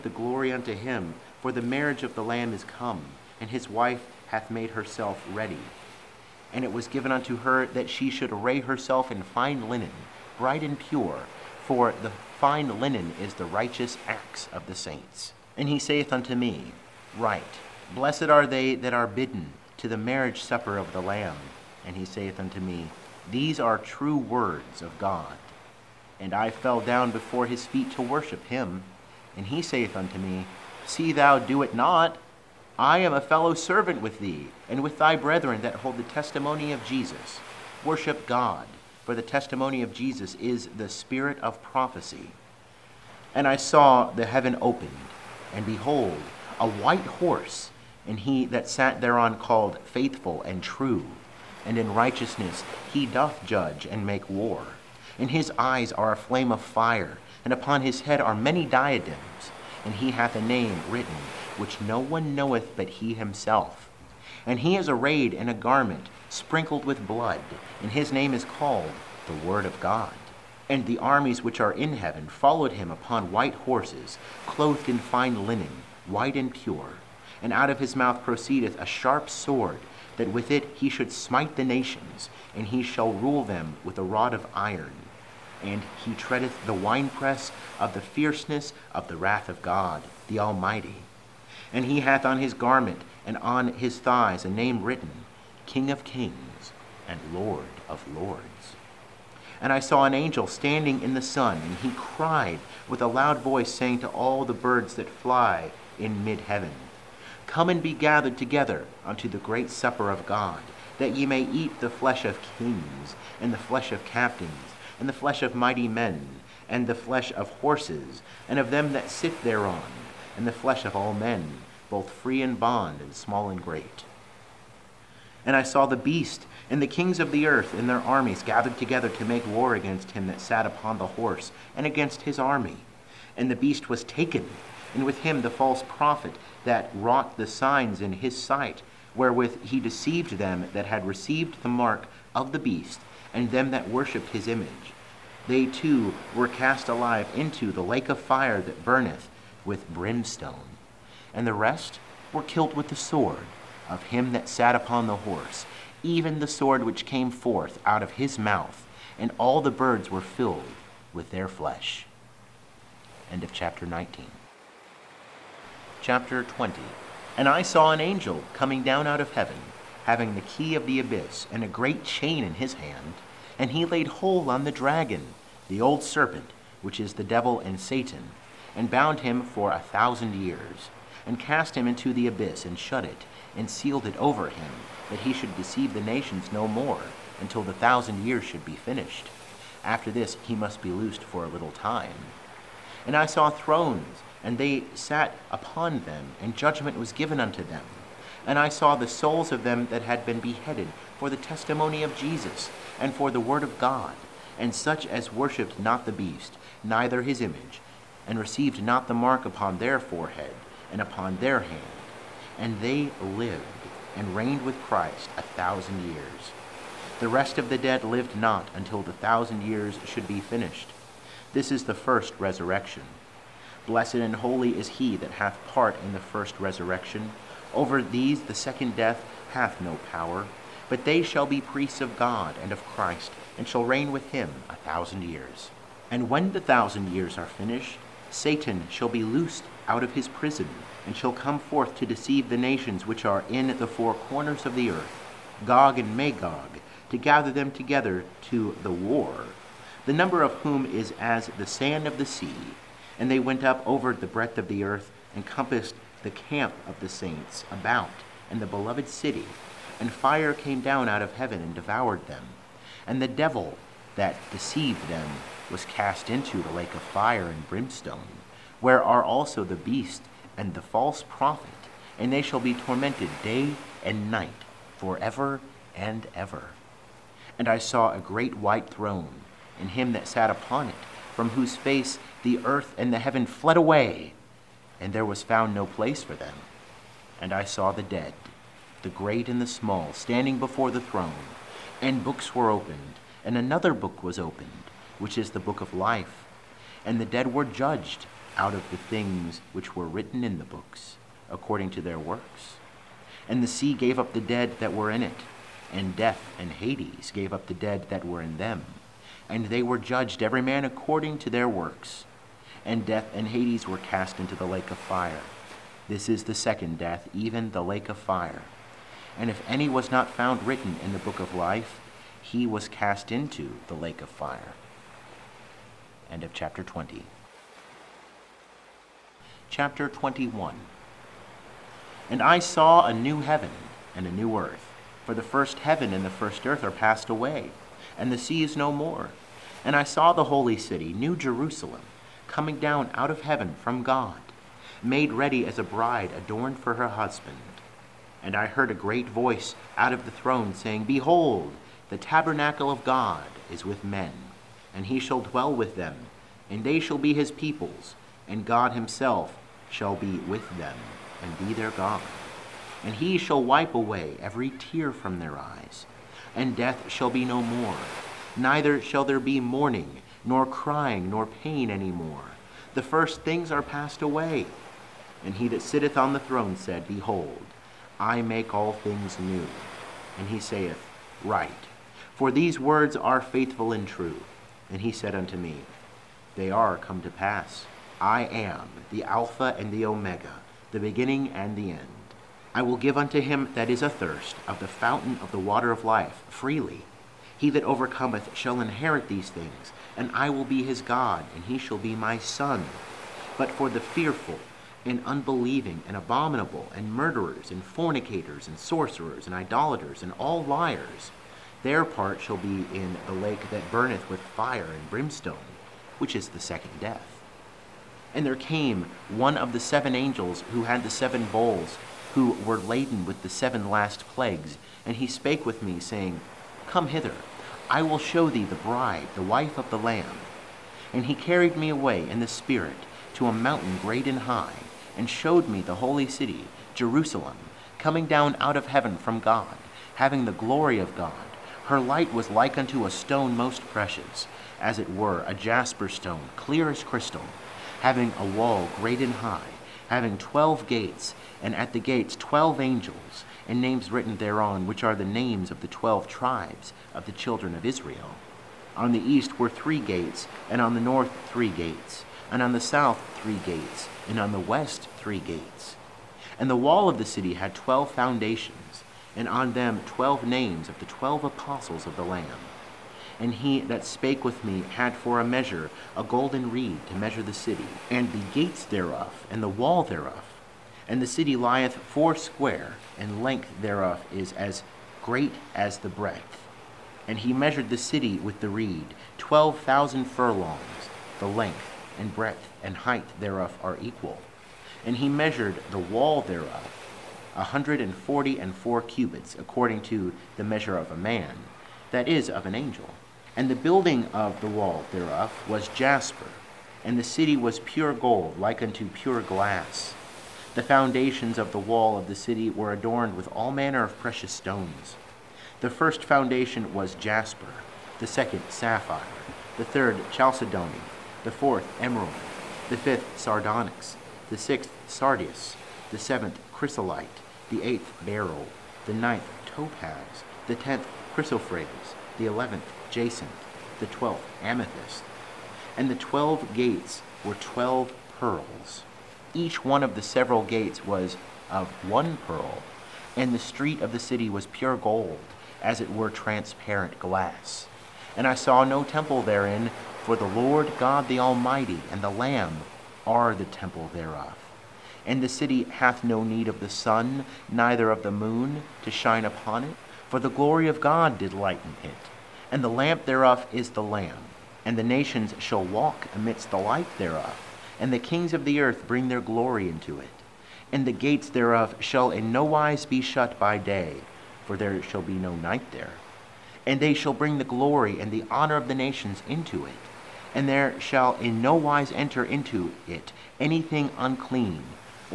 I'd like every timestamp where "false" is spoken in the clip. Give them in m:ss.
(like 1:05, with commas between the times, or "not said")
2:15, 4:30.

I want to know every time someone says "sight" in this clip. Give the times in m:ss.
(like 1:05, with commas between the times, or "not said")
2:18.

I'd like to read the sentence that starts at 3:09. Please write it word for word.
After this he must be loosed for a little time.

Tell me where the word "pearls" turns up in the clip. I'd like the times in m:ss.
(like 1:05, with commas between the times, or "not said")
8:58, 9:02.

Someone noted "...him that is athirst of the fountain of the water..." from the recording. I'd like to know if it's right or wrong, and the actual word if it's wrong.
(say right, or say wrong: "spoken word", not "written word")
right.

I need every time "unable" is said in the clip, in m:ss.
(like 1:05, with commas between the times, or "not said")
not said.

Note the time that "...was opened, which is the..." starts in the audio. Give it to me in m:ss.
4:54.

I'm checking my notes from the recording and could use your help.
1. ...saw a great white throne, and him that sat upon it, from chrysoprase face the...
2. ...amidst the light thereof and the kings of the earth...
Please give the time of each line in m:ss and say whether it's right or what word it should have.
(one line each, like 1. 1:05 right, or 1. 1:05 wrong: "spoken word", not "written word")
1. 4:37 wrong: "whose", not "chrysoprase"
2. 9:26 right.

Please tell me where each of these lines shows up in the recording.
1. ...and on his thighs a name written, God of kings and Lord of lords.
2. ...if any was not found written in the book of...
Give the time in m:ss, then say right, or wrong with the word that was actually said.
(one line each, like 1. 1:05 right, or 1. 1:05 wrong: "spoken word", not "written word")
1. 1:33 wrong: "King", not "God"
2. 5:19 right.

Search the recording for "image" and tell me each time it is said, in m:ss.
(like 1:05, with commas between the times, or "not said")
2:24, 3:27.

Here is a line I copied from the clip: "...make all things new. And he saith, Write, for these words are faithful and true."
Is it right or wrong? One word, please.
right.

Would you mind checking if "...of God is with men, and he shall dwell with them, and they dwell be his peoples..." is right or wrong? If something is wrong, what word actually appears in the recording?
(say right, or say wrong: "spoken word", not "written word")
wrong: "shall", not "dwell".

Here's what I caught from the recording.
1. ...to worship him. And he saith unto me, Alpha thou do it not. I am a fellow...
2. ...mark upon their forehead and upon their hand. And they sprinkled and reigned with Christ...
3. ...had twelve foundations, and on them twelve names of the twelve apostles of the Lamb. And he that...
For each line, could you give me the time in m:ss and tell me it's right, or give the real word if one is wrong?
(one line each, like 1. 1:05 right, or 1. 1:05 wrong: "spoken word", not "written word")
1. 0:27 wrong: "See", not "Alpha"
2. 3:29 wrong: "lived", not "sprinkled"
3. 7:47 right.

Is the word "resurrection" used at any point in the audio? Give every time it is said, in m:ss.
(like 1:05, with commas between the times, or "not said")
3:42, 3:46.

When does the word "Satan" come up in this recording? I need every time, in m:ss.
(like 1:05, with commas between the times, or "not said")
2:57, 3:58.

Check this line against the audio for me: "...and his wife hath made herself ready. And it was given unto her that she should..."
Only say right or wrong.
right.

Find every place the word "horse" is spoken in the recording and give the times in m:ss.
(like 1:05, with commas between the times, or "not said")
0:47, 1:13, 1:57, 2:11, 2:35.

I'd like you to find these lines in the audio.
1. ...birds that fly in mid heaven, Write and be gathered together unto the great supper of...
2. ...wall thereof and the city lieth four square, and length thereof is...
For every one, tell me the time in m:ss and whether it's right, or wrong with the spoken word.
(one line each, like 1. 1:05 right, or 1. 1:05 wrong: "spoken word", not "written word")
1. 1:44 wrong: "Come", not "Write"
2. 7:59 right.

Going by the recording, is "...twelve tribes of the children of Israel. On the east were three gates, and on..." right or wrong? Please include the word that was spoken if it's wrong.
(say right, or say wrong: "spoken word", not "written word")
right.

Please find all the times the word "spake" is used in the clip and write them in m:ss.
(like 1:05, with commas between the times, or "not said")
7:05, 7:54.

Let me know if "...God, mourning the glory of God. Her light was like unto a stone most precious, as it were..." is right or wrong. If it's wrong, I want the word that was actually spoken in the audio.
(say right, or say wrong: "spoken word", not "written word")
wrong: "having", not "mourning".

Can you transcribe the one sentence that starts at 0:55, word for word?
And his eyes are a flame of fire, and upon his head are many diadems.